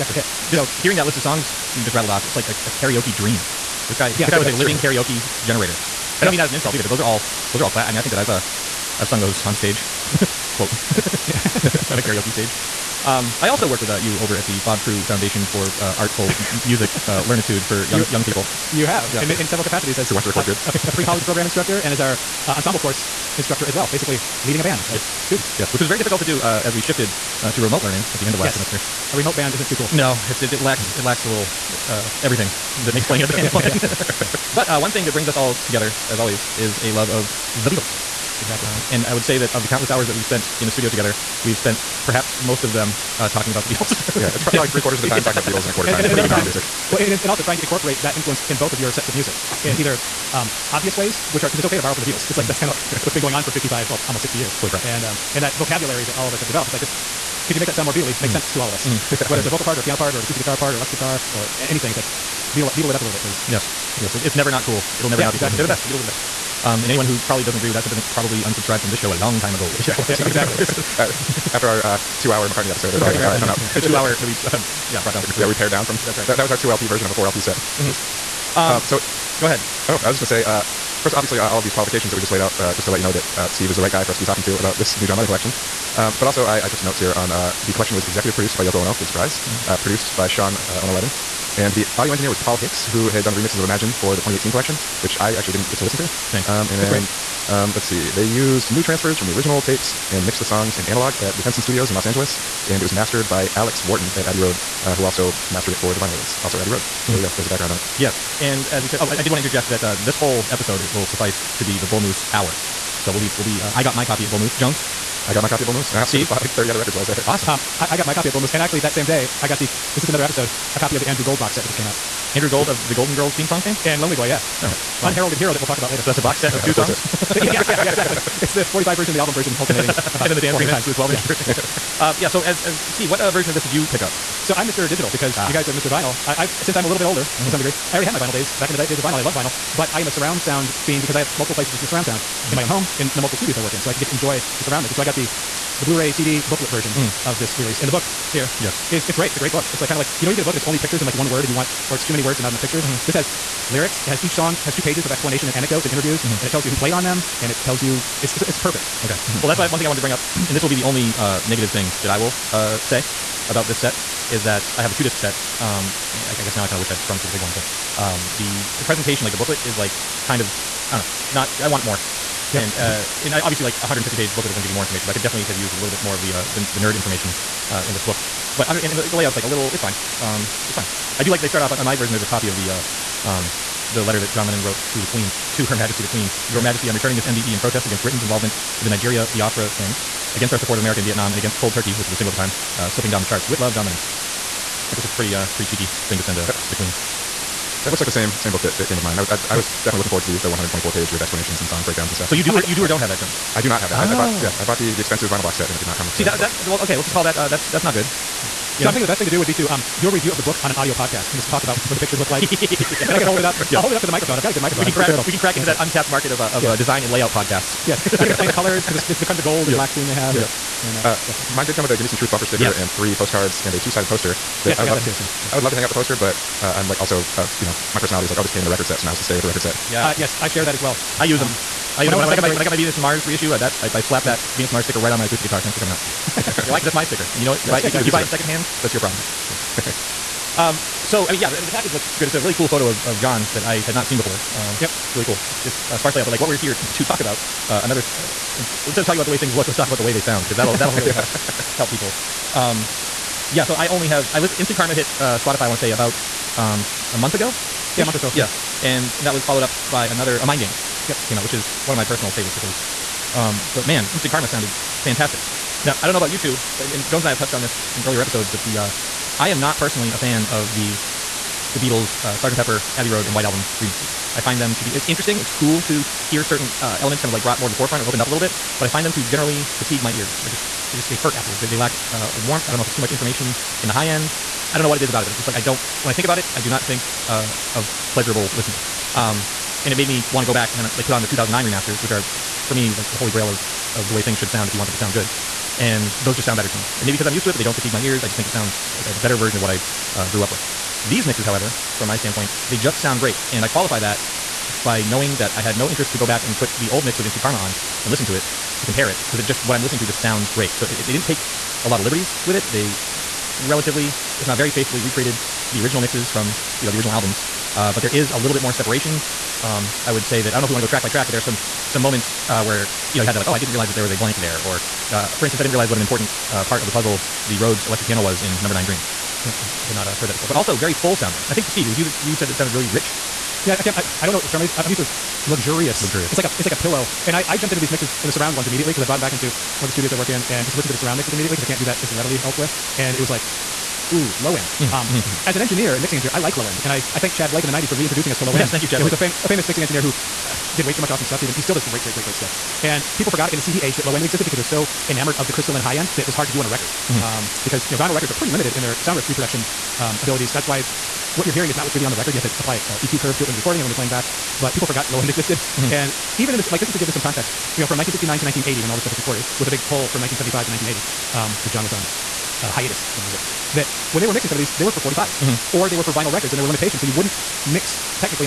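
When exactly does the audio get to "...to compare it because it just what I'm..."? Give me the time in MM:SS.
05:08.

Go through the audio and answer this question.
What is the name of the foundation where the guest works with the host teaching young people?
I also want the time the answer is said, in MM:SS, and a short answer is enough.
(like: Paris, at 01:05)
Bob Crewe Foundation, at 00:14.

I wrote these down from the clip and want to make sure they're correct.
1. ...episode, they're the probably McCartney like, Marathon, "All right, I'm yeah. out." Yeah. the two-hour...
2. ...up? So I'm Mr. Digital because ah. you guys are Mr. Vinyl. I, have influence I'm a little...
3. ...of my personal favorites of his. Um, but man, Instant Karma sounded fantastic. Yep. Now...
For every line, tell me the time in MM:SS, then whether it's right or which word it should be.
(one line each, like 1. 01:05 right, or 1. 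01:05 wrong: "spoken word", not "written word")
1. 01:12 right
2. 02:14 wrong: "since", not "influence"
3. 04:21 right.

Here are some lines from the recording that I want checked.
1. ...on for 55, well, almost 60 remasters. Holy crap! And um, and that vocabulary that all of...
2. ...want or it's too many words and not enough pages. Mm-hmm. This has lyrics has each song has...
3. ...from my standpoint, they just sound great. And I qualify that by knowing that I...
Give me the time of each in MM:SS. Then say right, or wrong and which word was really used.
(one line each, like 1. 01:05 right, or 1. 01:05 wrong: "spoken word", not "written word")
1. 00:53 wrong: "years", not "remasters"
2. 02:31 wrong: "pictures", not "pages"
3. 05:01 right.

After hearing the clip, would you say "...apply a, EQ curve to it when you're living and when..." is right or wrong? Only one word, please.
wrong.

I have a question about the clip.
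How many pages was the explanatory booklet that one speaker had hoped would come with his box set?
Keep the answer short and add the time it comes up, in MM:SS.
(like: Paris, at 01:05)
124, at 03:20.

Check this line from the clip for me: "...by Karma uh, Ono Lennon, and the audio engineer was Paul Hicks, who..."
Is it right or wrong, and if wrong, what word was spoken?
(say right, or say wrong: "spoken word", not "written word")
wrong: "Sean", not "Karma".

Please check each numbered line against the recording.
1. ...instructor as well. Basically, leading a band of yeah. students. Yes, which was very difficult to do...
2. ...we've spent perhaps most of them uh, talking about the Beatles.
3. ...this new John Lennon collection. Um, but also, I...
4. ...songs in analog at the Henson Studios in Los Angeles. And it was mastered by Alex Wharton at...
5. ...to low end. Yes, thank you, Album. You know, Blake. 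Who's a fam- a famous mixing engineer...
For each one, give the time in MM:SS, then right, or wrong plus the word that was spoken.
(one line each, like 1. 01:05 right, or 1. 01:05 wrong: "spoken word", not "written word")
1. 00:23 right
2. 00:41 right
3. 01:24 right
4. 01:40 right
5. 05:48 wrong: "Tchad", not "Album".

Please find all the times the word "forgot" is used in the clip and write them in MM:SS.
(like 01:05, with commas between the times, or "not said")
05:53, 06:04.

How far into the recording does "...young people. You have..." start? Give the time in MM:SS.
00:18.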